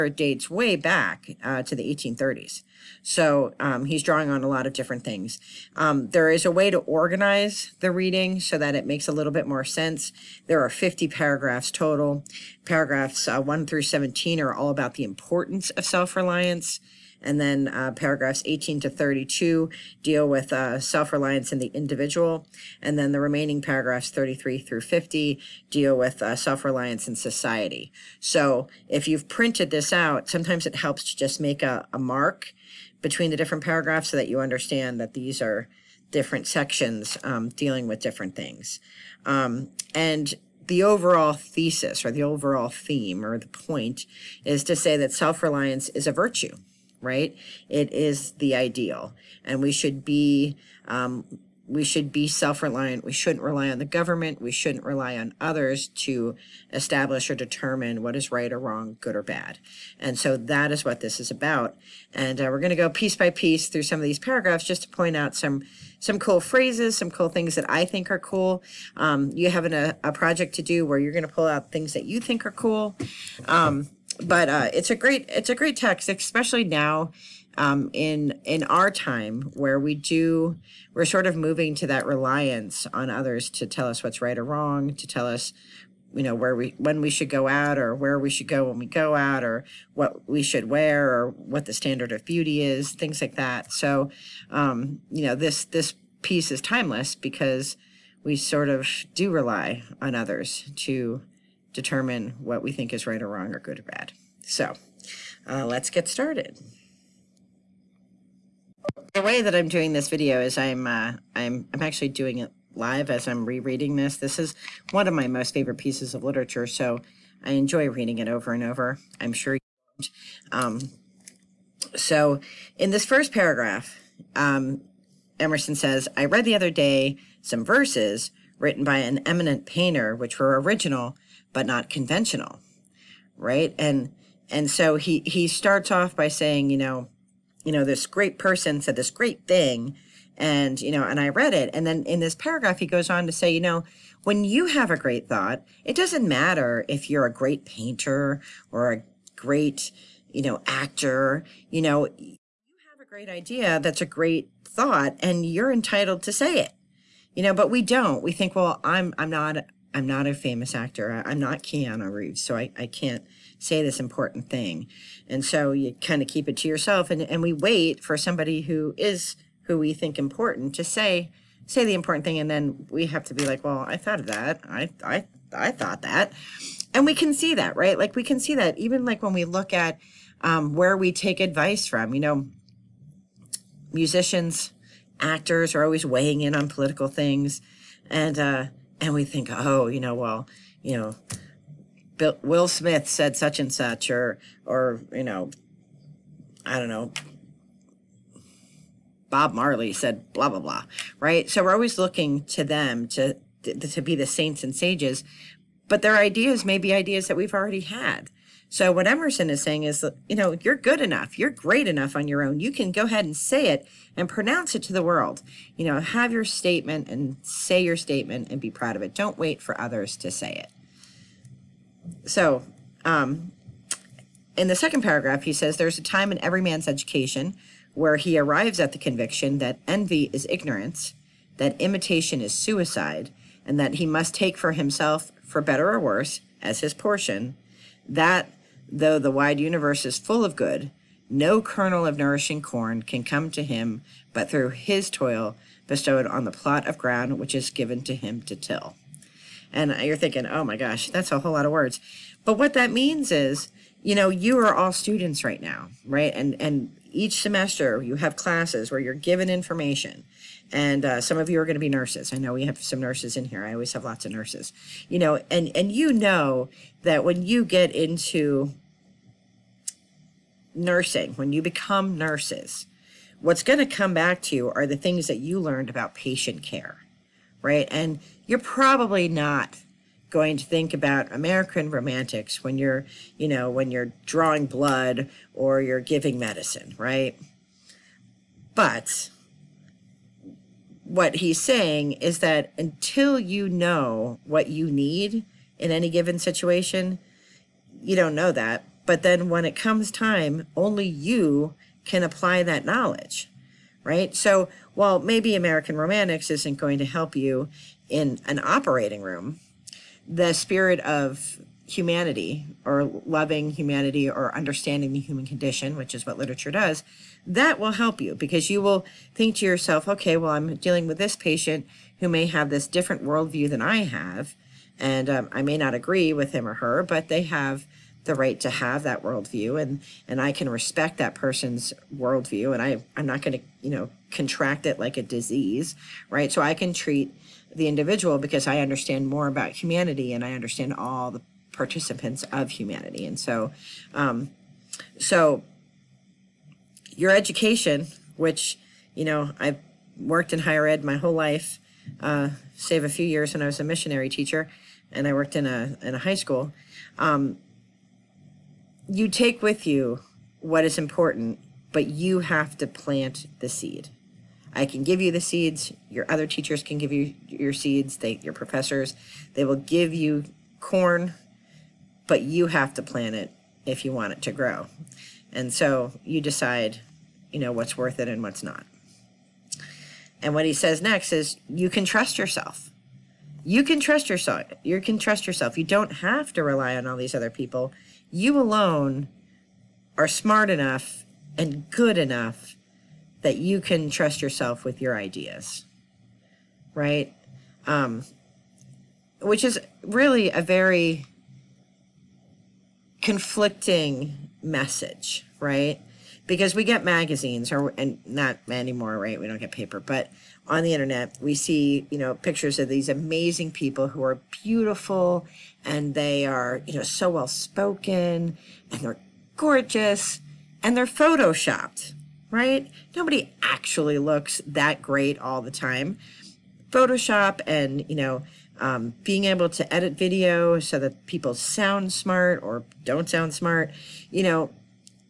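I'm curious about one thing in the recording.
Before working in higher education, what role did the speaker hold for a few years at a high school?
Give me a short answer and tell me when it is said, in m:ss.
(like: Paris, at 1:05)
missionary teacher, at 5:53.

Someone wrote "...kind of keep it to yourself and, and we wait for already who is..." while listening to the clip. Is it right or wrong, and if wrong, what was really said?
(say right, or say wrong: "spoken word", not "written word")
wrong: "somebody", not "already".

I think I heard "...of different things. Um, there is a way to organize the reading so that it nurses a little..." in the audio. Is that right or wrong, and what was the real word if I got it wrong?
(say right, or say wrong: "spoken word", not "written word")
wrong: "makes", not "nurses".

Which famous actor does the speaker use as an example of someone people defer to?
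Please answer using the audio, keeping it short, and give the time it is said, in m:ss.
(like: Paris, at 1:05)
Keanu Reeves, at 2:41.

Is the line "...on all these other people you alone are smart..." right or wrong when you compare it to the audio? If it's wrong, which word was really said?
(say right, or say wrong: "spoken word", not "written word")
right.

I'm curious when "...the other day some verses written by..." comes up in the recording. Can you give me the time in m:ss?
2:06.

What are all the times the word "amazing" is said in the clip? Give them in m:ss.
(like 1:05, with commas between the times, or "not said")
6:53.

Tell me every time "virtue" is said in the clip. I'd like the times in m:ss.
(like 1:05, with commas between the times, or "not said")
0:46.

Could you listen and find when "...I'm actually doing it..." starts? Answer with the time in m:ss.
1:51.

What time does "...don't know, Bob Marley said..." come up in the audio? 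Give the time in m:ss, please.
3:16.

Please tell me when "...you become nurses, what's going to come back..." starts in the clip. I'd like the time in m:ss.
4:31.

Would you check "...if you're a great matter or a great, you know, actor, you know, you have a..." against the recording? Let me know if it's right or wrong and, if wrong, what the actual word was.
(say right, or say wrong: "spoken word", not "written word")
wrong: "painter", not "matter".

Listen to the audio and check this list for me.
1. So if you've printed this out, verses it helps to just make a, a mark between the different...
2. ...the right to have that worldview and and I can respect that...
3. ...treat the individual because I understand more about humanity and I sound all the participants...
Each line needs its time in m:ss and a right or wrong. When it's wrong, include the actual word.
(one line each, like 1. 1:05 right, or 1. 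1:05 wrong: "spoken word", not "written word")
1. 0:28 wrong: "sometimes", not "verses"
2. 5:28 right
3. 5:36 wrong: "understand", not "sound".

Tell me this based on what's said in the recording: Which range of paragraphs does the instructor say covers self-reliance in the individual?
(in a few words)
18 to 32.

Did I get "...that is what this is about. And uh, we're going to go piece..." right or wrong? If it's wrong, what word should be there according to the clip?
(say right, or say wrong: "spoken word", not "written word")
right.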